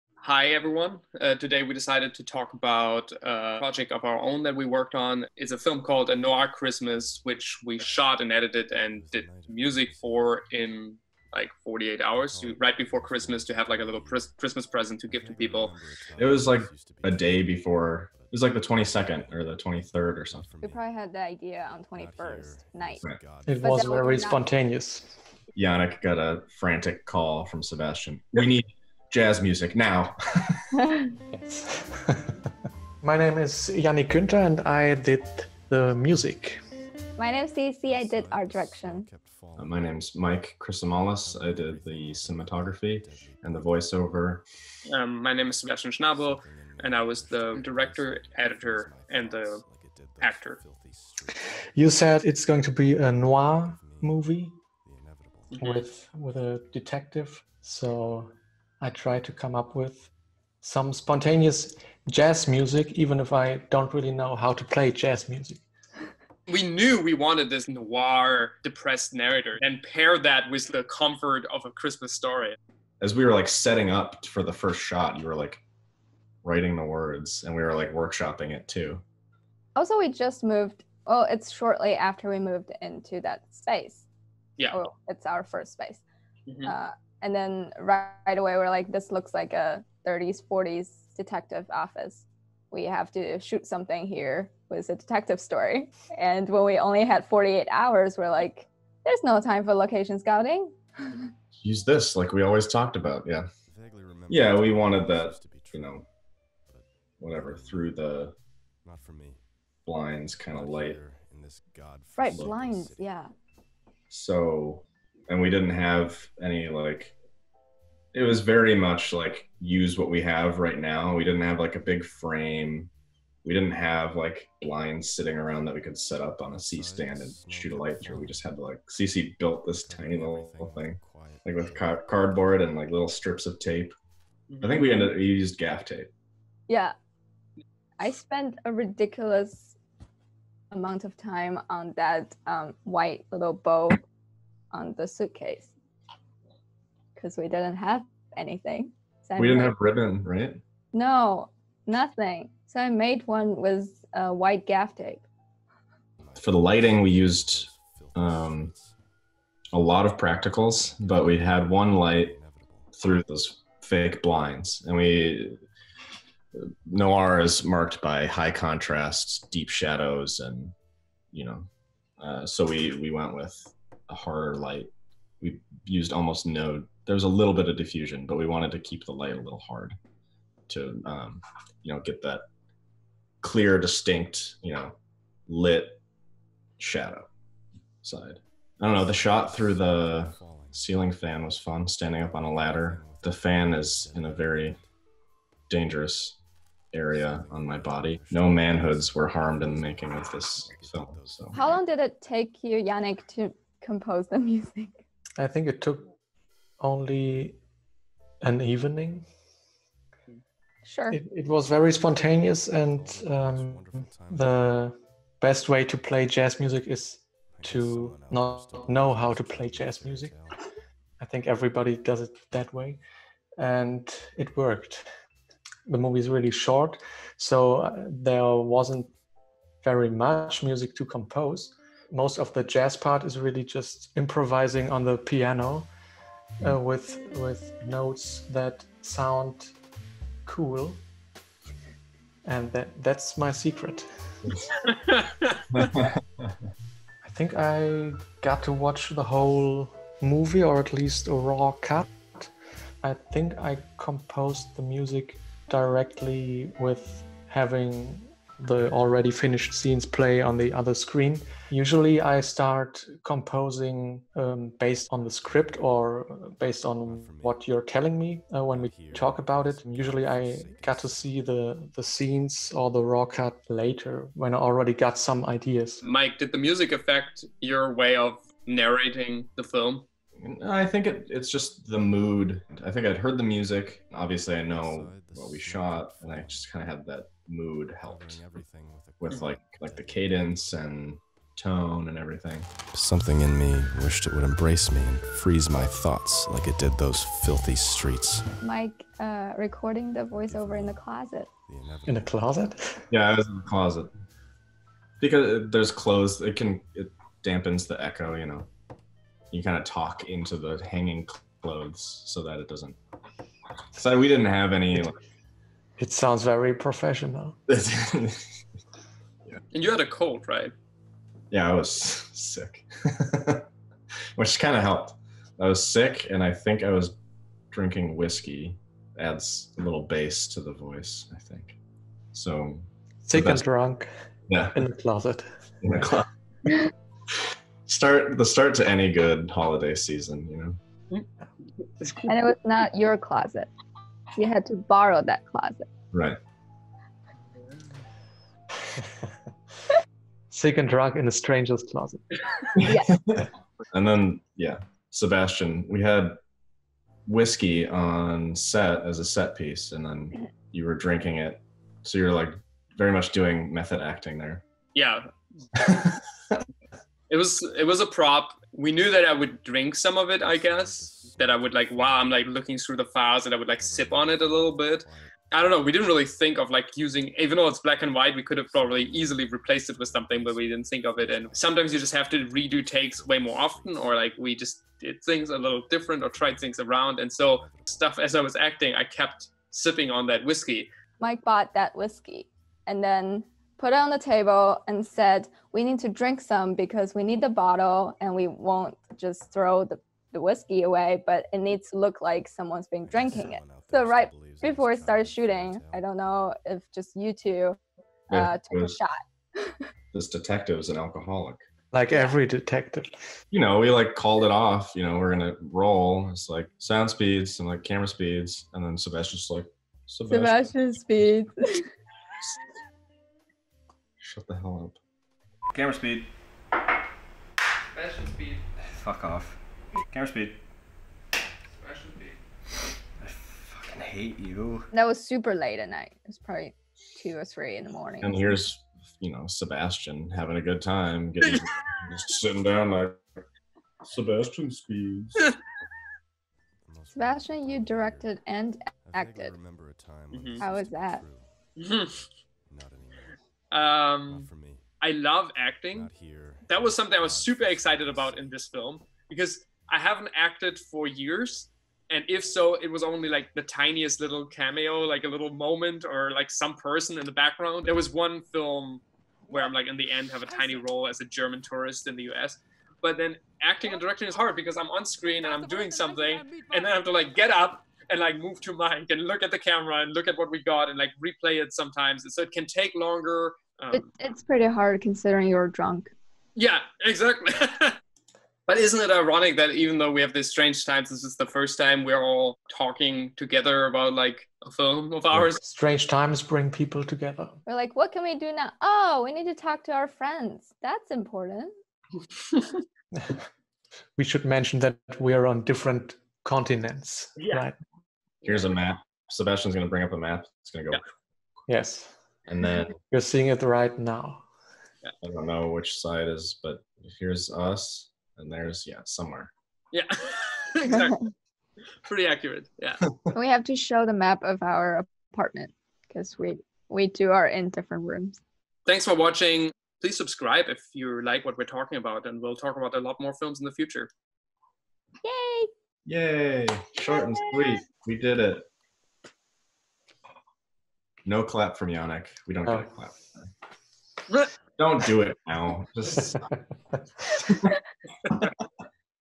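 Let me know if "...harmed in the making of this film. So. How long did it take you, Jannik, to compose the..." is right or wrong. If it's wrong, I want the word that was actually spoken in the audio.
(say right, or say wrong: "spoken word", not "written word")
right.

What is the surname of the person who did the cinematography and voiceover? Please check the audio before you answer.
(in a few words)
Chryssomallis.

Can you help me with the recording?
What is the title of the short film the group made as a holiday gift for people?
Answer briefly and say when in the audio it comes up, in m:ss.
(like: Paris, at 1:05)
A Noir Christmas, at 0:06.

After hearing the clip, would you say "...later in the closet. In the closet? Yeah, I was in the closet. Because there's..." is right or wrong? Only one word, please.
wrong.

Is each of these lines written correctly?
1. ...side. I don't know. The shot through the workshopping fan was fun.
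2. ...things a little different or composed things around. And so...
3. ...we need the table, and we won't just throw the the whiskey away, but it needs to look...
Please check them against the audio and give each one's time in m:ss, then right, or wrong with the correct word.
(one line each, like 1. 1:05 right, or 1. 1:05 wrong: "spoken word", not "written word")
1. 3:08 wrong: "ceiling", not "workshopping"
2. 6:25 wrong: "tried", not "composed"
3. 6:37 wrong: "bottle", not "table".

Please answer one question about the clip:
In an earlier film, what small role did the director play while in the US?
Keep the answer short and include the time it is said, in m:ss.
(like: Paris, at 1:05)
German tourist, at 7:51.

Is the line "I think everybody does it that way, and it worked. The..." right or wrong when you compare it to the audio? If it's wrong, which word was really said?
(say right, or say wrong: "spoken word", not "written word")
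right.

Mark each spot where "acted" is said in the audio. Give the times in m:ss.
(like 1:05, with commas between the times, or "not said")
7:29, 7:40.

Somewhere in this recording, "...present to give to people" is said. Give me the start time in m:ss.
0:14.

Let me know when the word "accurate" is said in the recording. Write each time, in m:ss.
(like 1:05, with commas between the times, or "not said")
8:42.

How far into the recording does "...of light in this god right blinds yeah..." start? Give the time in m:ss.
1:50.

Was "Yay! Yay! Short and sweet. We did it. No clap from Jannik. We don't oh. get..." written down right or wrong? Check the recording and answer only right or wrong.
right.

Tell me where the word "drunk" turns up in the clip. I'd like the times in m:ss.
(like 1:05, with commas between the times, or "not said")
5:33, 5:50, 8:05.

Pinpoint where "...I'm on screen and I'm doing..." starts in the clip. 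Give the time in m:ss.
7:54.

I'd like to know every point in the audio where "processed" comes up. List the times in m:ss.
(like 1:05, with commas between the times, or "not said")
not said.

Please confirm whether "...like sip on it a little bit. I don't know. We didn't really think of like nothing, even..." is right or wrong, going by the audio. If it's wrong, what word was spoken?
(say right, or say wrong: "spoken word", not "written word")
wrong: "using", not "nothing".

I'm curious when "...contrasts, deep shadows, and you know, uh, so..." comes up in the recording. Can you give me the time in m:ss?
2:48.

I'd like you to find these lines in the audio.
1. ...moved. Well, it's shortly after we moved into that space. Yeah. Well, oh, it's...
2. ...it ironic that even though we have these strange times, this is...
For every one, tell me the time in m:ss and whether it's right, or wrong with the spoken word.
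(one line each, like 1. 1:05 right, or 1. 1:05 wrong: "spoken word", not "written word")
1. 1:20 right
2. 8:08 right.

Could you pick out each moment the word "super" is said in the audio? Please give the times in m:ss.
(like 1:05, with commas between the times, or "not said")
7:15, 7:37.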